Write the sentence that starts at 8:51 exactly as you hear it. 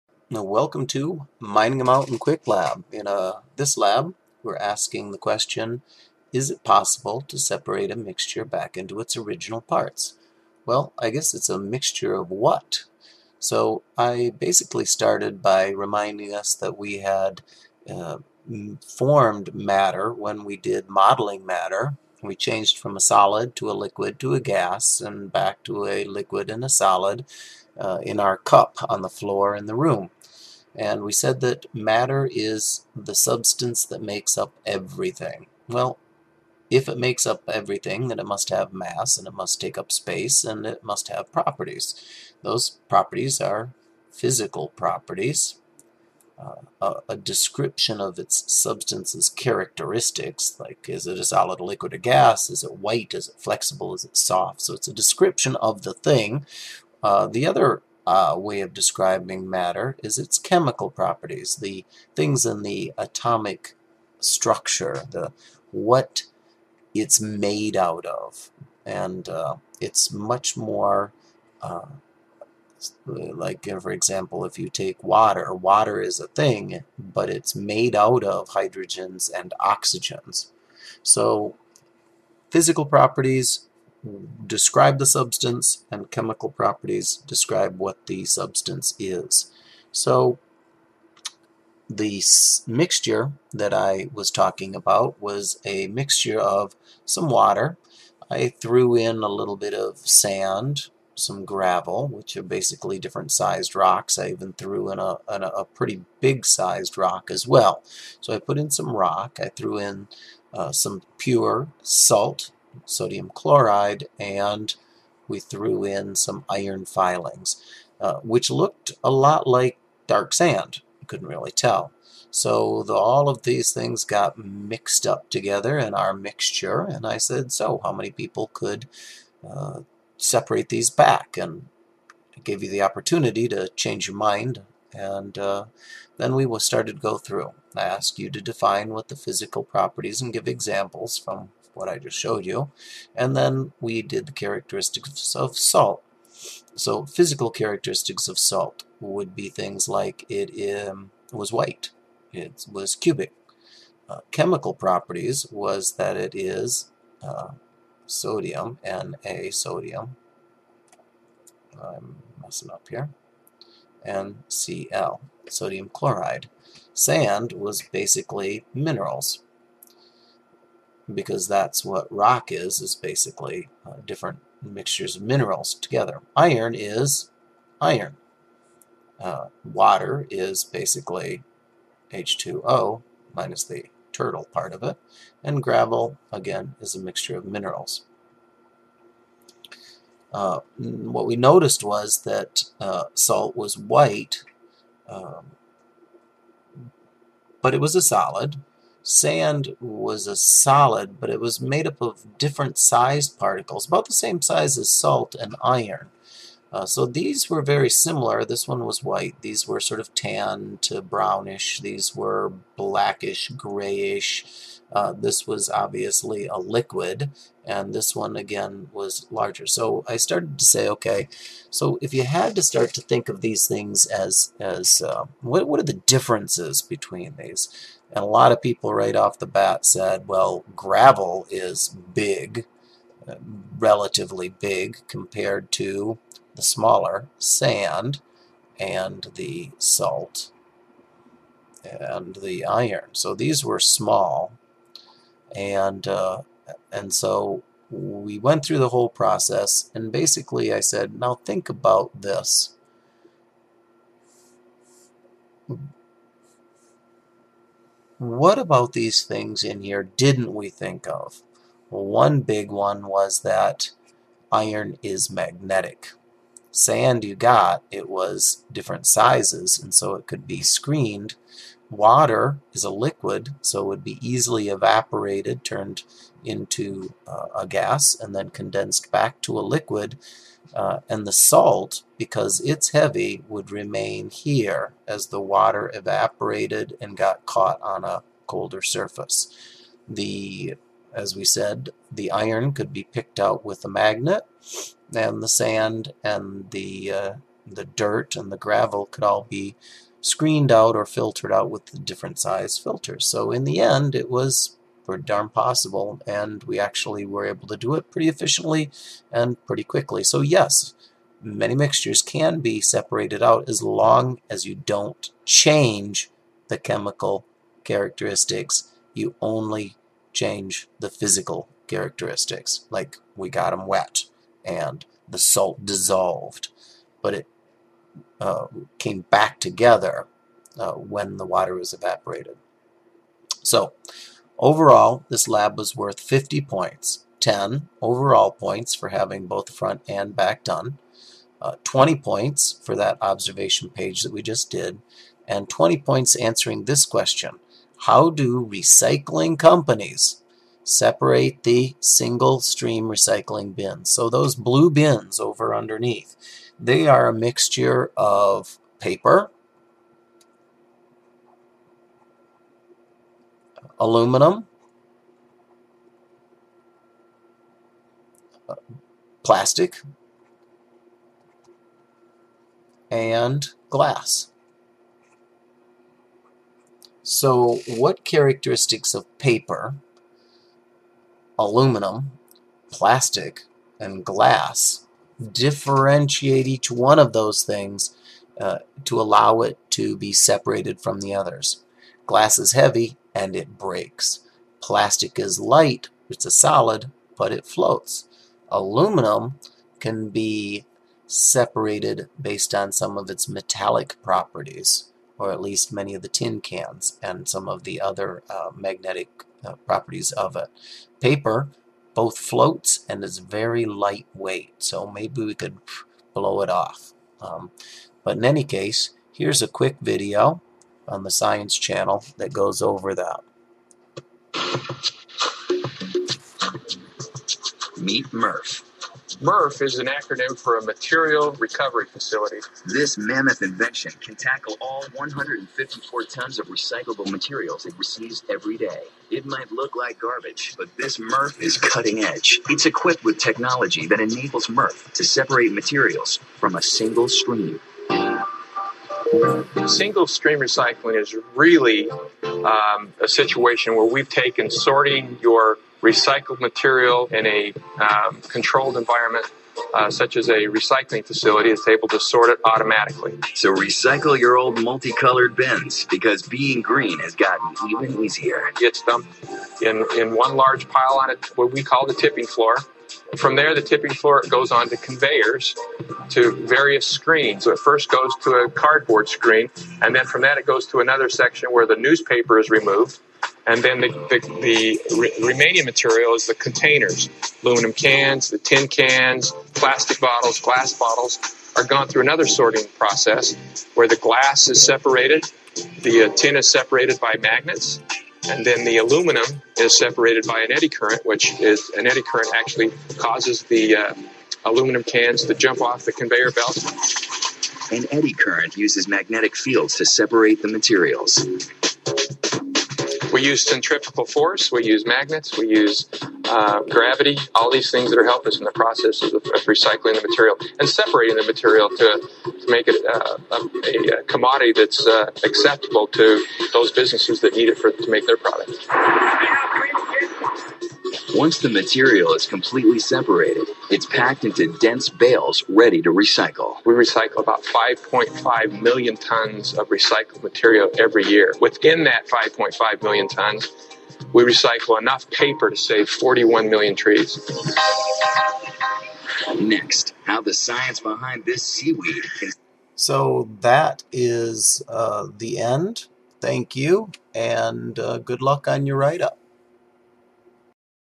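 Once the material is completely separated, it's packed into dense bales ready to recycle.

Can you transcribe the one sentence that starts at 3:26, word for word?
Uh, so these were very similar.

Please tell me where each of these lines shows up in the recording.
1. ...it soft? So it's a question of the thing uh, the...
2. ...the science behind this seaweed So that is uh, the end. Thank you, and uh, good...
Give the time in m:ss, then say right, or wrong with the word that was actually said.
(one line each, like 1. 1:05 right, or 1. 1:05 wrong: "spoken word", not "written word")
1. 0:54 wrong: "description", not "question"
2. 9:10 right.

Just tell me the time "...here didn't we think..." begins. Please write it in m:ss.
4:19.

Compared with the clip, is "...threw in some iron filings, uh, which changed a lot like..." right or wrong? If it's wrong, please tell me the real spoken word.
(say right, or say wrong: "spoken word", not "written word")
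wrong: "looked", not "changed".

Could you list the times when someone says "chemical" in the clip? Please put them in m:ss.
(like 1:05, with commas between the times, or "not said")
1:00, 1:26, 2:34, 5:16.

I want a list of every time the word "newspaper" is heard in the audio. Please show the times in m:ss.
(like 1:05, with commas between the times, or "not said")
8:01.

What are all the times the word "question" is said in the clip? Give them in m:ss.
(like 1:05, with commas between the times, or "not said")
0:05, 5:47.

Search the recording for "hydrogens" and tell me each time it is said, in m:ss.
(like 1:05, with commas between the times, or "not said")
1:18.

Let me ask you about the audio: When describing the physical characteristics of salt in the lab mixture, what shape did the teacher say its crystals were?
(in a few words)
cubic.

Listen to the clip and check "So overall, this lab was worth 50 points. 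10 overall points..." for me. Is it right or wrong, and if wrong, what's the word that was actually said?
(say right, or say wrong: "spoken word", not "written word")
right.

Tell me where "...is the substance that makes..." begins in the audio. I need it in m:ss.
0:32.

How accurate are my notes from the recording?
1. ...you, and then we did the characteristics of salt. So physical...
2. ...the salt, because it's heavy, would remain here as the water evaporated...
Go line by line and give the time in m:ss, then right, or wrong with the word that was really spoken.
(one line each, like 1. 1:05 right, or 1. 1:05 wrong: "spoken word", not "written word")
1. 2:22 right
2. 4:41 right.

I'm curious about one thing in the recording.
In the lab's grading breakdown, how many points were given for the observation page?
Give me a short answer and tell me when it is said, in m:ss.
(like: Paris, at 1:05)
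20, at 5:41.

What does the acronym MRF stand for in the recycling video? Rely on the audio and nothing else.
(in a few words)
material recovery facility.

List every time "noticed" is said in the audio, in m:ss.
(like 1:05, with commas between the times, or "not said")
3:11.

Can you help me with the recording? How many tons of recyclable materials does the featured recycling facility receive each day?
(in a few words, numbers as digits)
154 tons.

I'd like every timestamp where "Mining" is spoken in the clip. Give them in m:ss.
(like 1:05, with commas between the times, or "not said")
0:01.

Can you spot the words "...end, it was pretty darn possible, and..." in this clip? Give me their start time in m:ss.
5:03.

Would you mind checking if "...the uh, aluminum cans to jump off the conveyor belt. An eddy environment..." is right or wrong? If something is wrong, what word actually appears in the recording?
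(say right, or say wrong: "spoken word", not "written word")
wrong: "current", not "environment".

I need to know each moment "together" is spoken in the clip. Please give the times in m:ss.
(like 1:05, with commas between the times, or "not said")
2:05, 2:55, 5:29.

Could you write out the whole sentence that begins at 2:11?
And I gave you the opportunity to change your mind and uh, then we will start to go through.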